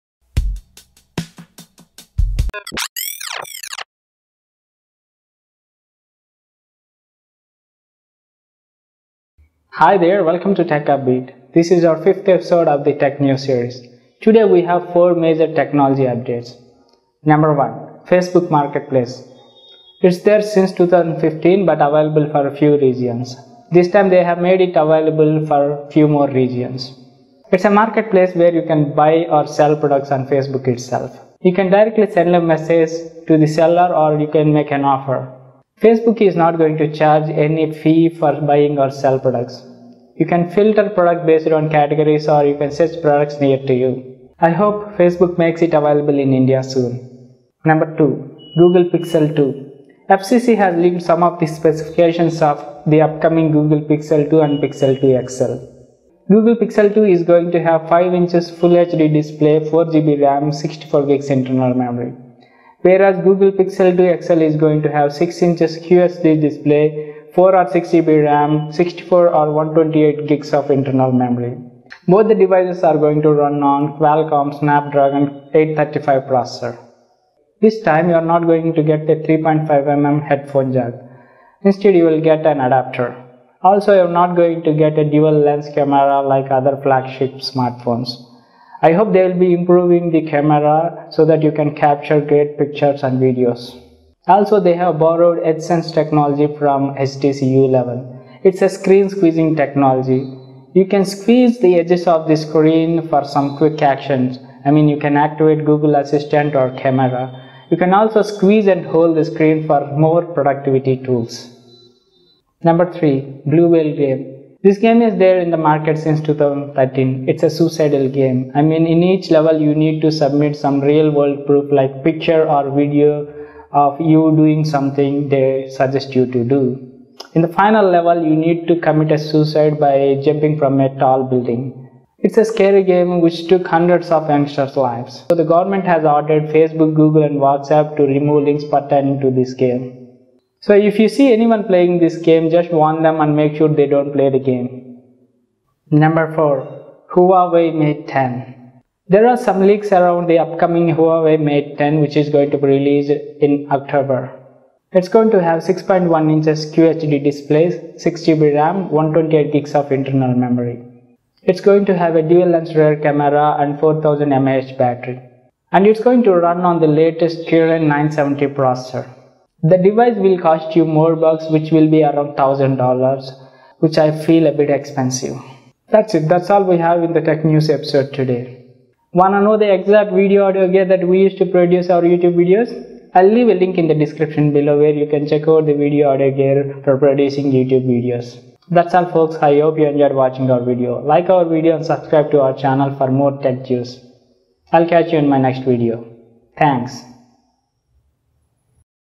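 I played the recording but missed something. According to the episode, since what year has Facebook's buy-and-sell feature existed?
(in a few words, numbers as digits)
2015.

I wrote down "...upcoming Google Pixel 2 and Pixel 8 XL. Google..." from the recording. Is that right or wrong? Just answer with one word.
wrong.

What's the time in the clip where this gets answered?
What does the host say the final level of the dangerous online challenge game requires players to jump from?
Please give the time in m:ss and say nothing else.
2:10.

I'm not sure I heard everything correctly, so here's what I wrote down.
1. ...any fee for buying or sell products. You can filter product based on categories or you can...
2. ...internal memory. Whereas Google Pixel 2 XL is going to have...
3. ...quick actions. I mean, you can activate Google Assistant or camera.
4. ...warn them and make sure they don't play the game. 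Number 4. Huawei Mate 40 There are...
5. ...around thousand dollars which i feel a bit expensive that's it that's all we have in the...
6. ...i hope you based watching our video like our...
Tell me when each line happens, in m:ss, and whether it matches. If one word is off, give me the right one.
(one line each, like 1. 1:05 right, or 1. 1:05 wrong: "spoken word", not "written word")
1. 0:37 right
2. 1:01 right
3. 1:43 right
4. 2:22 wrong: "10", not "40"
5. 2:52 right
6. 3:09 wrong: "enjoyed", not "based".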